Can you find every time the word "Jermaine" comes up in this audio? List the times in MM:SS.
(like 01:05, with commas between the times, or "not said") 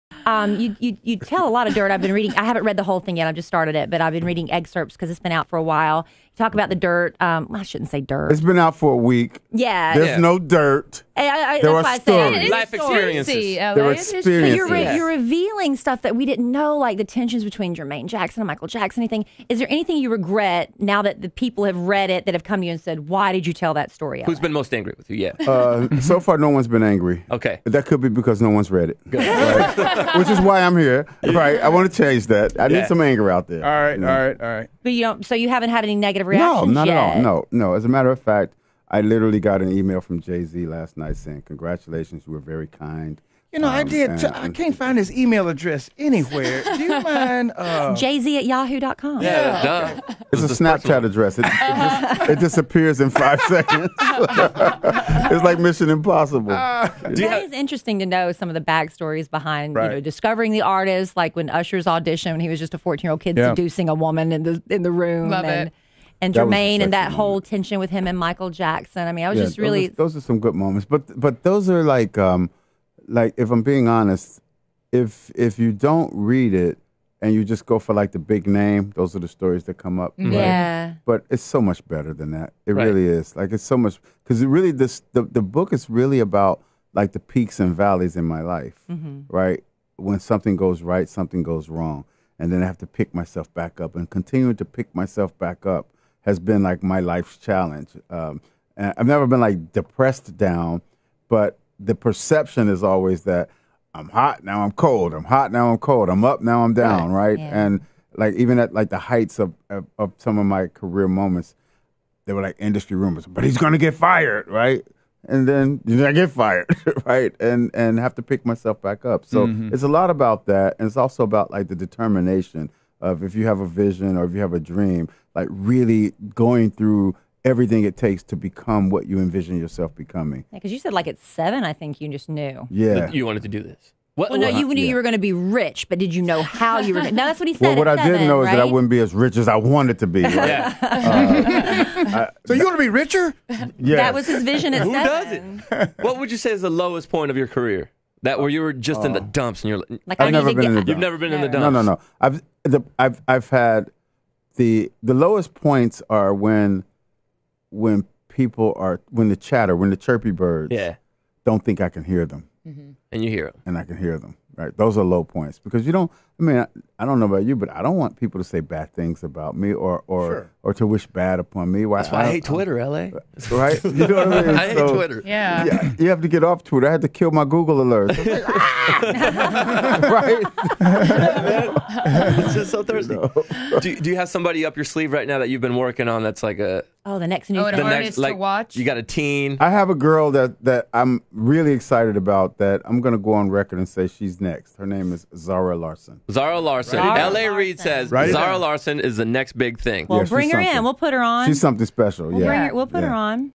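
00:17, 01:06.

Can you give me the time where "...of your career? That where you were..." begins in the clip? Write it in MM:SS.
02:27.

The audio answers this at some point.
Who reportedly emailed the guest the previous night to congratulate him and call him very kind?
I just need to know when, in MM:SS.
00:40.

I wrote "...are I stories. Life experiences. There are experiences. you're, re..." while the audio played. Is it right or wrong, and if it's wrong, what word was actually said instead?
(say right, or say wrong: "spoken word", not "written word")
right.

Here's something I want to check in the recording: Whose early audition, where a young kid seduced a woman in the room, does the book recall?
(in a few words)
Usher.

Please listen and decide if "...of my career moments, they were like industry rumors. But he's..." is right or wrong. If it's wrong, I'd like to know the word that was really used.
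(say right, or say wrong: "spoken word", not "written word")
right.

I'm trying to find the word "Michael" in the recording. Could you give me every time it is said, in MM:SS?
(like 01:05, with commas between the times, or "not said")
00:18, 01:08.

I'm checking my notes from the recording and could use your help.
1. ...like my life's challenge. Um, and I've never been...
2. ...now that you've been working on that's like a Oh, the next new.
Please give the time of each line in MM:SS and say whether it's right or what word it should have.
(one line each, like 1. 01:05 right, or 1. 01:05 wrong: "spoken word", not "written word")
1. 01:36 right
2. 03:05 right.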